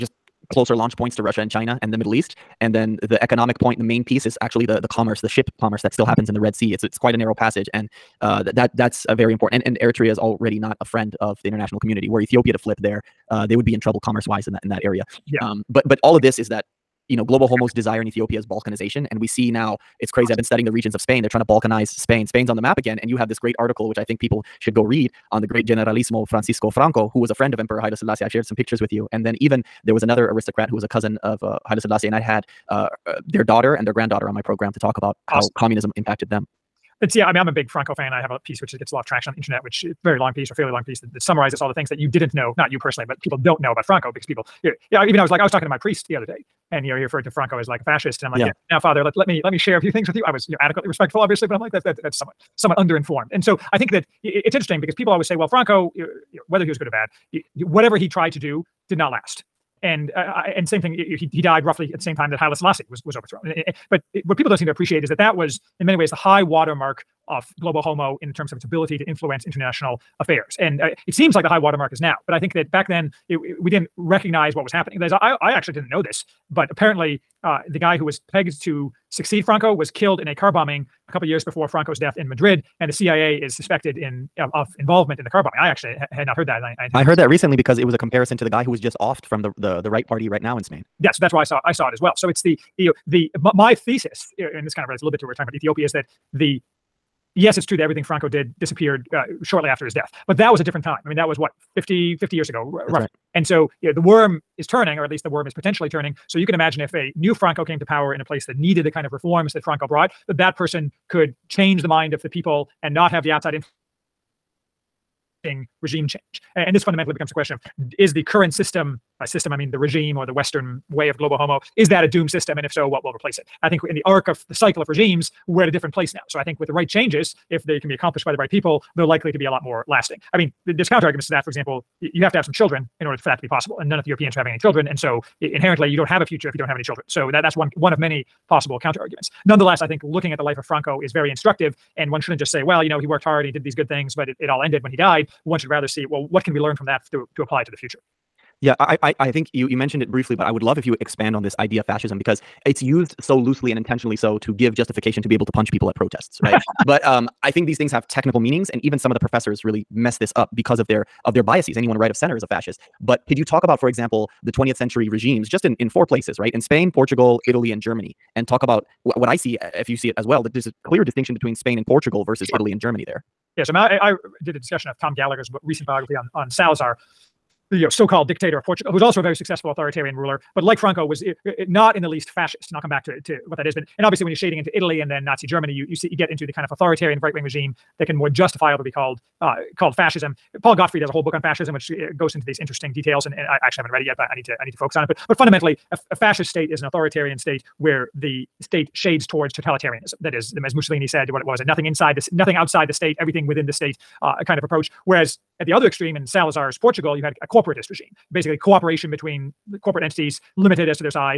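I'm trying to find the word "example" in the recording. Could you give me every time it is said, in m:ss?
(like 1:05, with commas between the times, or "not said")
2:11, 2:43.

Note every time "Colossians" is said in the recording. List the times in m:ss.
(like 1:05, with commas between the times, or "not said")
not said.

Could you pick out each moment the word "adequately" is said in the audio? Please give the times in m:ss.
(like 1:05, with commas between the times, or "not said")
0:50.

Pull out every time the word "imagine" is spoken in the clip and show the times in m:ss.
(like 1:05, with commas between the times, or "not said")
1:46.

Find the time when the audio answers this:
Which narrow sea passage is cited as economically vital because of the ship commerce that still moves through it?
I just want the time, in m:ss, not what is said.
0:06.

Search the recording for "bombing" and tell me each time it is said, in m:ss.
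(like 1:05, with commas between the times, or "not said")
1:20, 1:25.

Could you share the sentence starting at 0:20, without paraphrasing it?
I've been studying the regions of Spain.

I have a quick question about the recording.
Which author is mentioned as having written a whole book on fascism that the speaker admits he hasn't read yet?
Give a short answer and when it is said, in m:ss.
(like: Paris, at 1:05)
Paul Gottfried, at 3:10.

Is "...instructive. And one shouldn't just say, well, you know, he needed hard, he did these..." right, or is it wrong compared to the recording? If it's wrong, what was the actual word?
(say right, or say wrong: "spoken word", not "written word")
wrong: "worked", not "needed".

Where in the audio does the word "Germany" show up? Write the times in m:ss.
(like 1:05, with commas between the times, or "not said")
2:47, 2:52, 3:05.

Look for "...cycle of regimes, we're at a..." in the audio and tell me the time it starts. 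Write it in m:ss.
2:04.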